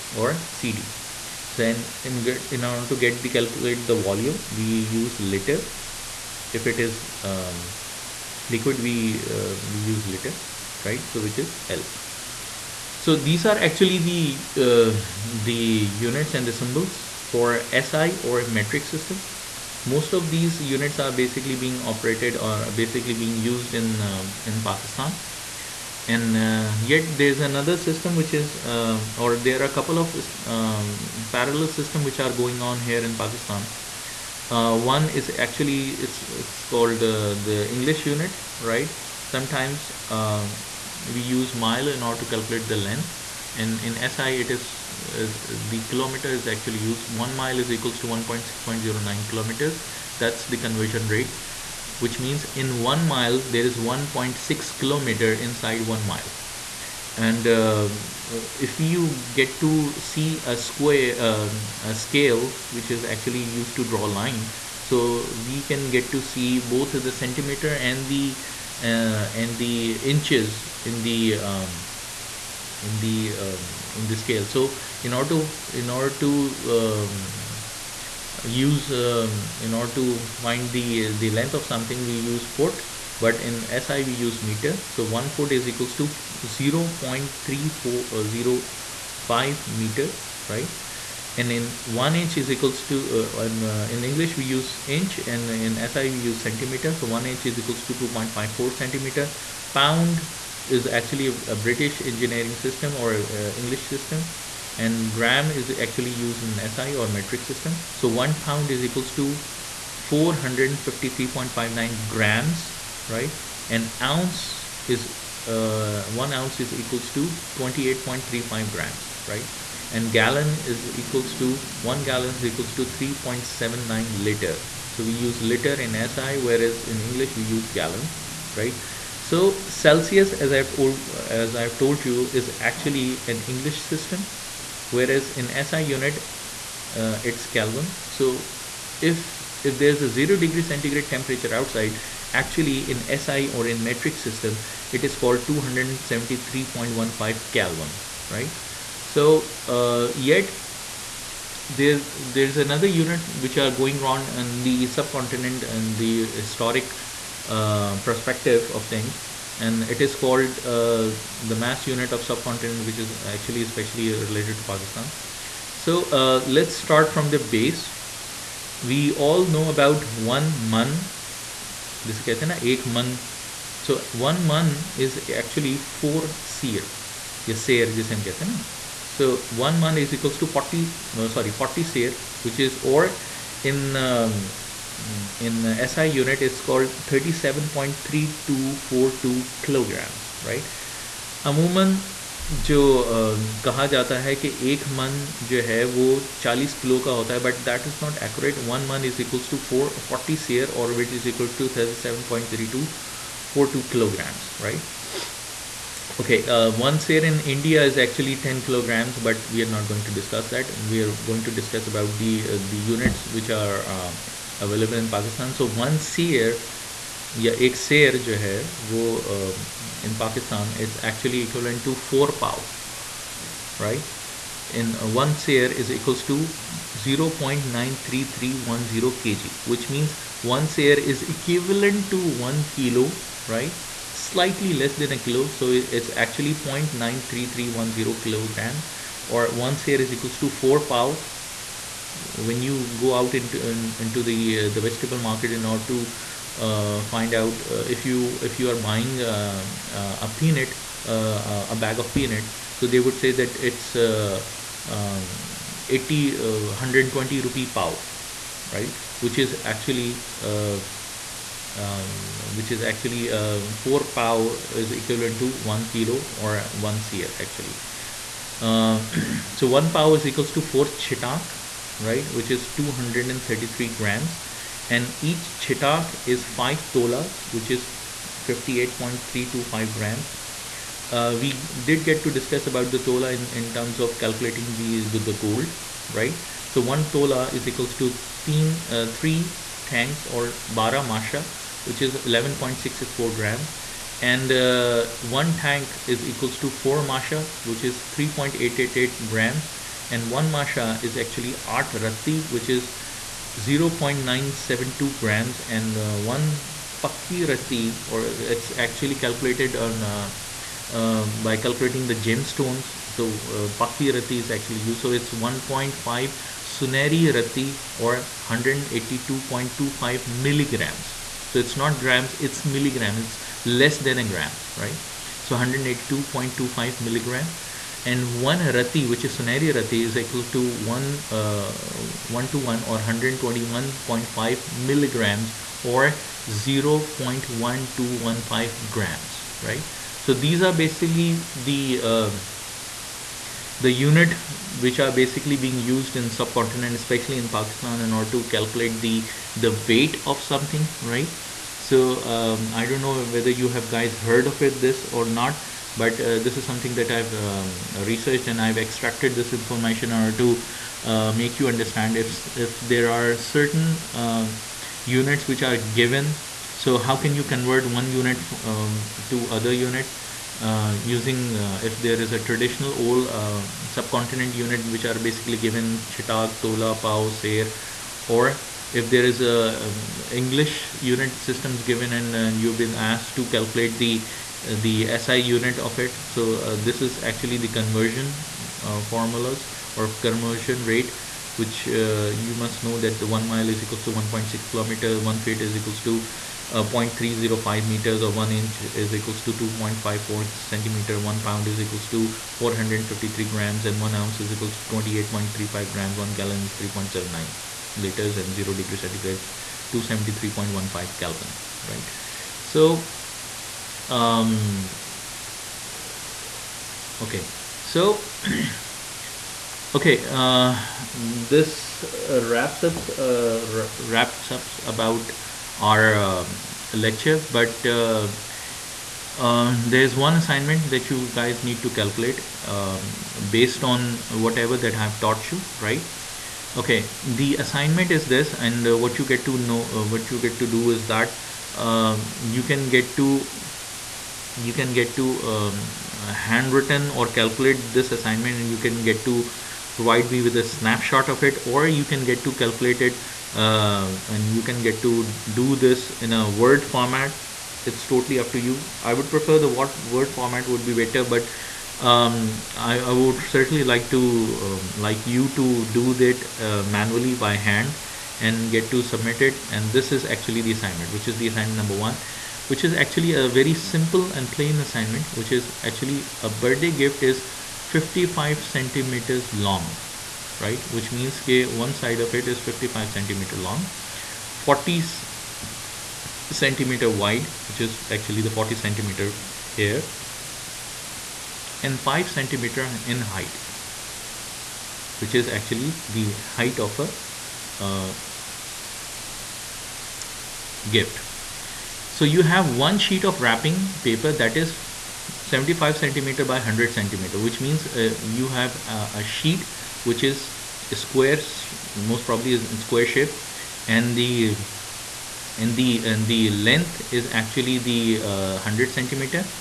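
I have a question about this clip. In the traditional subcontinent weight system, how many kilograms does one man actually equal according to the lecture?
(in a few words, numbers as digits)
37.3242 kilograms.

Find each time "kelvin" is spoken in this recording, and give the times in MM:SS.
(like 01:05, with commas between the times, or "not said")
02:17, 02:27, 06:51.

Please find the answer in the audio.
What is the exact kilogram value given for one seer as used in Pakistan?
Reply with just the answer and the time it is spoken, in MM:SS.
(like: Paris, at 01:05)
0.93310 kg, at 03:47.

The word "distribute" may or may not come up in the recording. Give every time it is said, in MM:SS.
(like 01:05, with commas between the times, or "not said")
not said.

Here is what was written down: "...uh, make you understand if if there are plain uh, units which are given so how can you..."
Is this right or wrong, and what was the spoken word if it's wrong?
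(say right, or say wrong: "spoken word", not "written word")
wrong: "certain", not "plain".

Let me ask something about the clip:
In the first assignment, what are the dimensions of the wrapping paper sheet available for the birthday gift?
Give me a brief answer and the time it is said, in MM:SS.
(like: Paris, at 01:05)
75 cm by 100 cm, at 08:25.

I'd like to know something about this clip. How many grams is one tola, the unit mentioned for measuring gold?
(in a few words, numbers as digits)
11.664 grams.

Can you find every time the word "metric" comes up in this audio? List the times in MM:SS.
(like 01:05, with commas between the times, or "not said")
00:18, 01:47, 02:23.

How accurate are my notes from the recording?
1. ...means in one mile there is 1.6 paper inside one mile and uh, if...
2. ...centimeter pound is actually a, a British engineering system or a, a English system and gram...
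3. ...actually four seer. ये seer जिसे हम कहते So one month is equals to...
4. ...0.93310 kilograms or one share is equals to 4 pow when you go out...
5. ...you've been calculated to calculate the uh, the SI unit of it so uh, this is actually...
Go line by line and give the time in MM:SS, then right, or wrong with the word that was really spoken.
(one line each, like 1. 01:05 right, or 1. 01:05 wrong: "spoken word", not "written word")
1. 00:52 wrong: "kilometer", not "paper"
2. 01:38 right
3. 02:55 right
4. 03:56 right
5. 06:22 wrong: "asked", not "calculated".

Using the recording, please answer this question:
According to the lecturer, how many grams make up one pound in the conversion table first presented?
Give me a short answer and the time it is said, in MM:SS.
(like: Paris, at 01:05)
453.59 grams, at 01:50.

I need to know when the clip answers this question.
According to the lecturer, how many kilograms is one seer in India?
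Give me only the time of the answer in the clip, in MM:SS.
03:28.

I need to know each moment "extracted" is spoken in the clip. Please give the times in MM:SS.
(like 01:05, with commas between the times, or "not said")
05:58.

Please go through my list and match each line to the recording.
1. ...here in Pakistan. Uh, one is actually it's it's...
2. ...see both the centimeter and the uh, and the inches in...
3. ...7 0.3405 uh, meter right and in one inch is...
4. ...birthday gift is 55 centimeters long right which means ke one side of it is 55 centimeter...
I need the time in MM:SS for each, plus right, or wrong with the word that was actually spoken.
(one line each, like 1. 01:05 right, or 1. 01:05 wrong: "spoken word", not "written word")
1. 00:32 right
2. 01:06 right
3. 01:26 wrong: "0", not "7"
4. 07:56 right.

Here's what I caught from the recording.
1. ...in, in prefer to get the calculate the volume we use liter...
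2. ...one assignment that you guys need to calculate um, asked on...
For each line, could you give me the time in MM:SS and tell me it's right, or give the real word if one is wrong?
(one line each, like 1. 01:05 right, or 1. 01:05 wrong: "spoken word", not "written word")
1. 00:01 wrong: "order", not "prefer"
2. 07:10 wrong: "based", not "asked".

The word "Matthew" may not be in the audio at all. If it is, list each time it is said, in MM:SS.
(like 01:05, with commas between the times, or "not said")
not said.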